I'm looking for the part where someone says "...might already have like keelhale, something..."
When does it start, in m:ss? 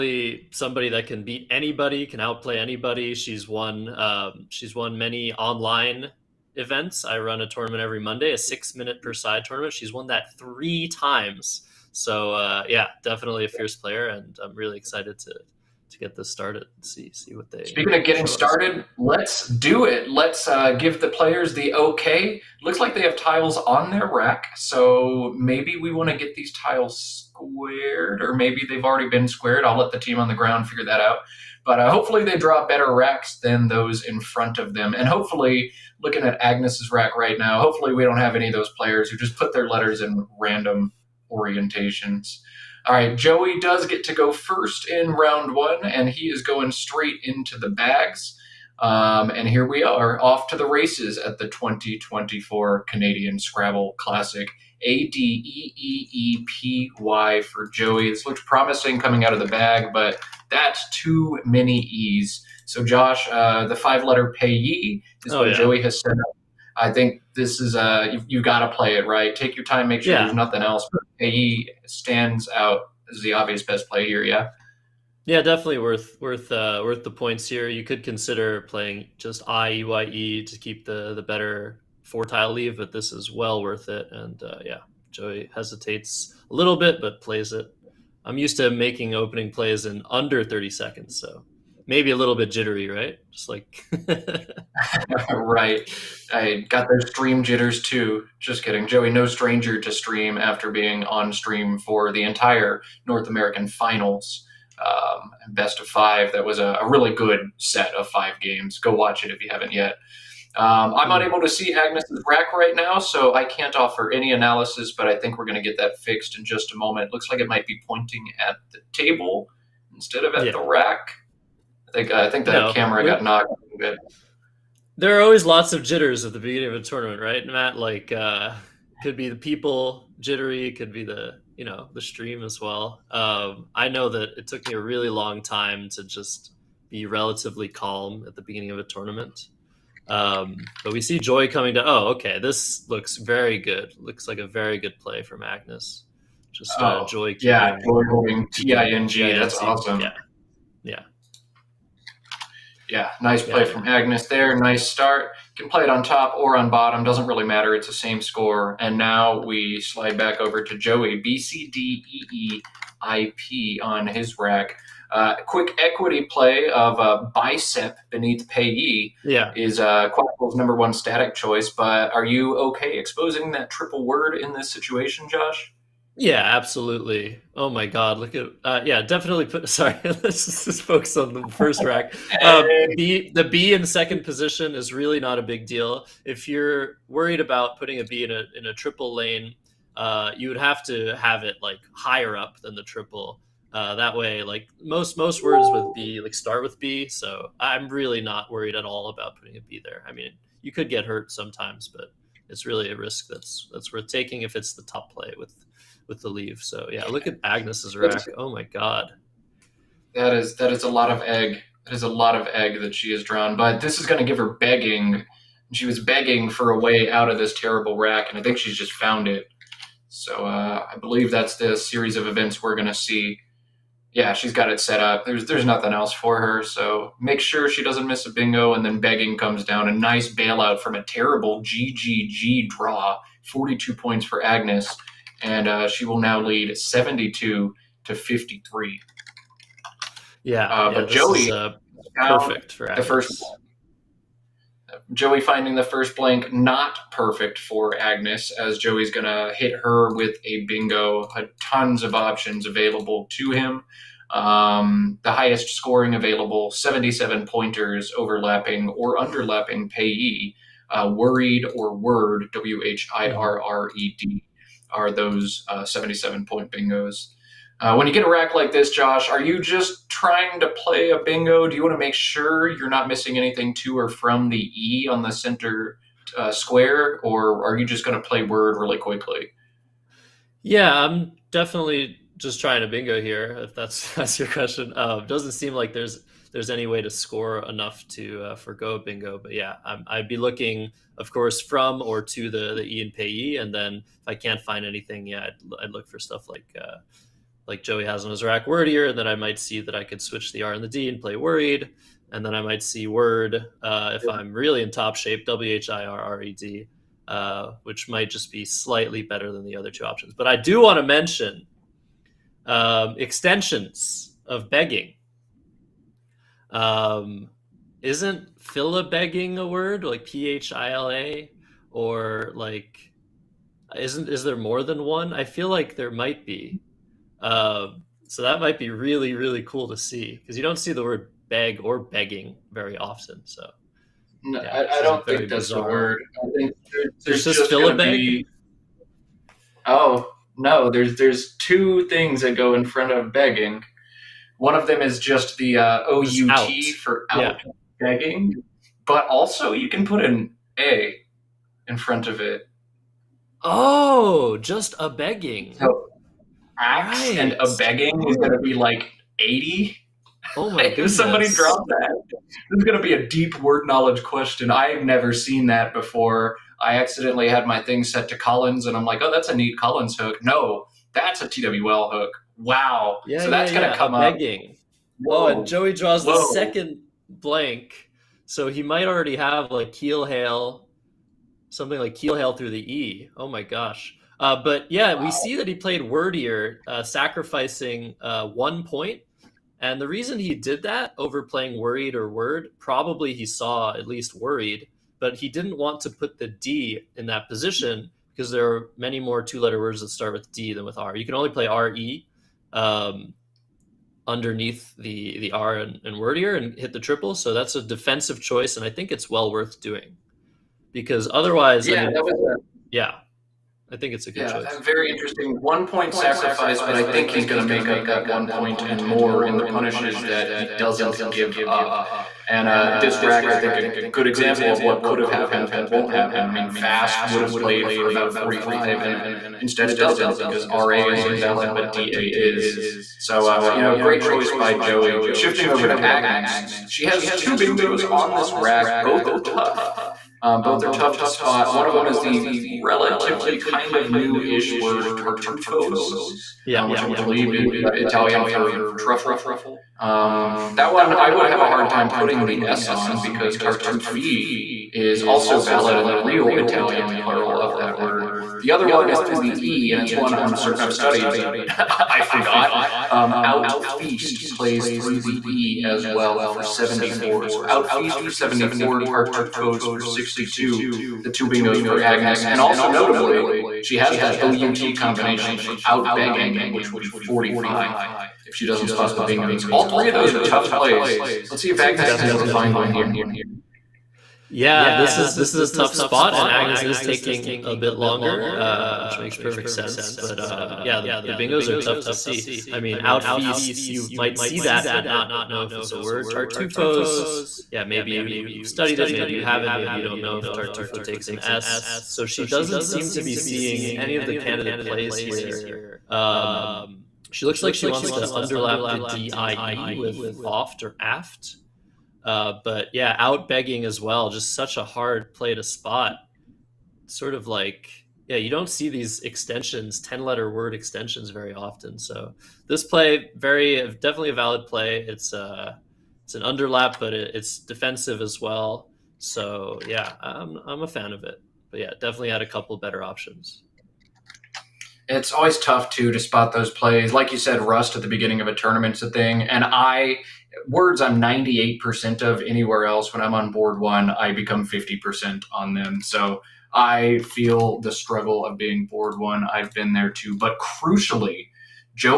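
6:18.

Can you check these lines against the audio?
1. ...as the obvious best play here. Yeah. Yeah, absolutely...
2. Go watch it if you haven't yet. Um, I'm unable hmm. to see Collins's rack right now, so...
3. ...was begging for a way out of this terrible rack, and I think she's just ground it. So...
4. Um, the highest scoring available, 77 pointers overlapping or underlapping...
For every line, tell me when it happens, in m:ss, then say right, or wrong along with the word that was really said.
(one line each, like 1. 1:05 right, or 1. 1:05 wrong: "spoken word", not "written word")
1. 1:13 wrong: "definitely", not "absolutely"
2. 1:48 wrong: "Agnes", not "Collins"
3. 3:35 wrong: "found", not "ground"
4. 4:14 right.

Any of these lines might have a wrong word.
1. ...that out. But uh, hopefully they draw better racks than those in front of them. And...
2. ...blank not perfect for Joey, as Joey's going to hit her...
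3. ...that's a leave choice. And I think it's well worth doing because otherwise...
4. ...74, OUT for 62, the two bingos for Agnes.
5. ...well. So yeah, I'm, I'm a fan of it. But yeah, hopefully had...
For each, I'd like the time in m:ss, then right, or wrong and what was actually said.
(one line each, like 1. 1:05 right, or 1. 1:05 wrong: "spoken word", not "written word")
1. 0:30 right
2. 4:06 wrong: "Agnes", not "Joey"
3. 6:47 wrong: "defensive", not "leave"
4. 7:48 wrong: "Tartufos", not "OUT"
5. 8:48 wrong: "definitely", not "hopefully".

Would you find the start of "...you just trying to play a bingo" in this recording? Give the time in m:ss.
4:29.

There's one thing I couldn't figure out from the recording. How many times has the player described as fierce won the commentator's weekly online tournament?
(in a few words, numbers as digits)
3.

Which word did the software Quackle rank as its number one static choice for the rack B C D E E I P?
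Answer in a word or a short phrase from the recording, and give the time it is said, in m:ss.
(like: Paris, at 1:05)
bicep, at 2:47.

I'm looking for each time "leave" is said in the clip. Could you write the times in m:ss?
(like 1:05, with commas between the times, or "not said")
1:22, 3:26.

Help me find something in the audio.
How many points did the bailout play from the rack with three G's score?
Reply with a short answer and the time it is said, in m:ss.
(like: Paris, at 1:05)
42, at 3:53.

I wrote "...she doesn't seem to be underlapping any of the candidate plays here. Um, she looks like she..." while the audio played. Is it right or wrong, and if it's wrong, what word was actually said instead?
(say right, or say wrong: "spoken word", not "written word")
wrong: "seeing", not "underlapping".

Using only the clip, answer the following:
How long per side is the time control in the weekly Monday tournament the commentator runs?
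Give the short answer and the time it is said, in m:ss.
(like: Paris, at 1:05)
6 minutes, at 0:08.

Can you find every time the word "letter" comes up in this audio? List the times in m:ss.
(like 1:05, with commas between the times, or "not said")
0:39, 1:04, 6:39, 8:40.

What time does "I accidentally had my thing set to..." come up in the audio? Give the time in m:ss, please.
6:06.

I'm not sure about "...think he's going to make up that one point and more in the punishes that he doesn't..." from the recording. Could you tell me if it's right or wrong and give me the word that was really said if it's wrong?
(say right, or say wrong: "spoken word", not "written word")
right.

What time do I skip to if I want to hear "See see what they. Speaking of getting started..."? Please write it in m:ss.
0:16.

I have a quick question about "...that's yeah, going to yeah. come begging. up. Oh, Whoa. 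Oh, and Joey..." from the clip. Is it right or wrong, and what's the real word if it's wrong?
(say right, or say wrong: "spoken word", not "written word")
right.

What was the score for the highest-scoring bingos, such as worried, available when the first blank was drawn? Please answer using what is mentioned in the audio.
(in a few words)
77.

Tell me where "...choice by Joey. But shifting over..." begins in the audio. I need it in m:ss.
7:14.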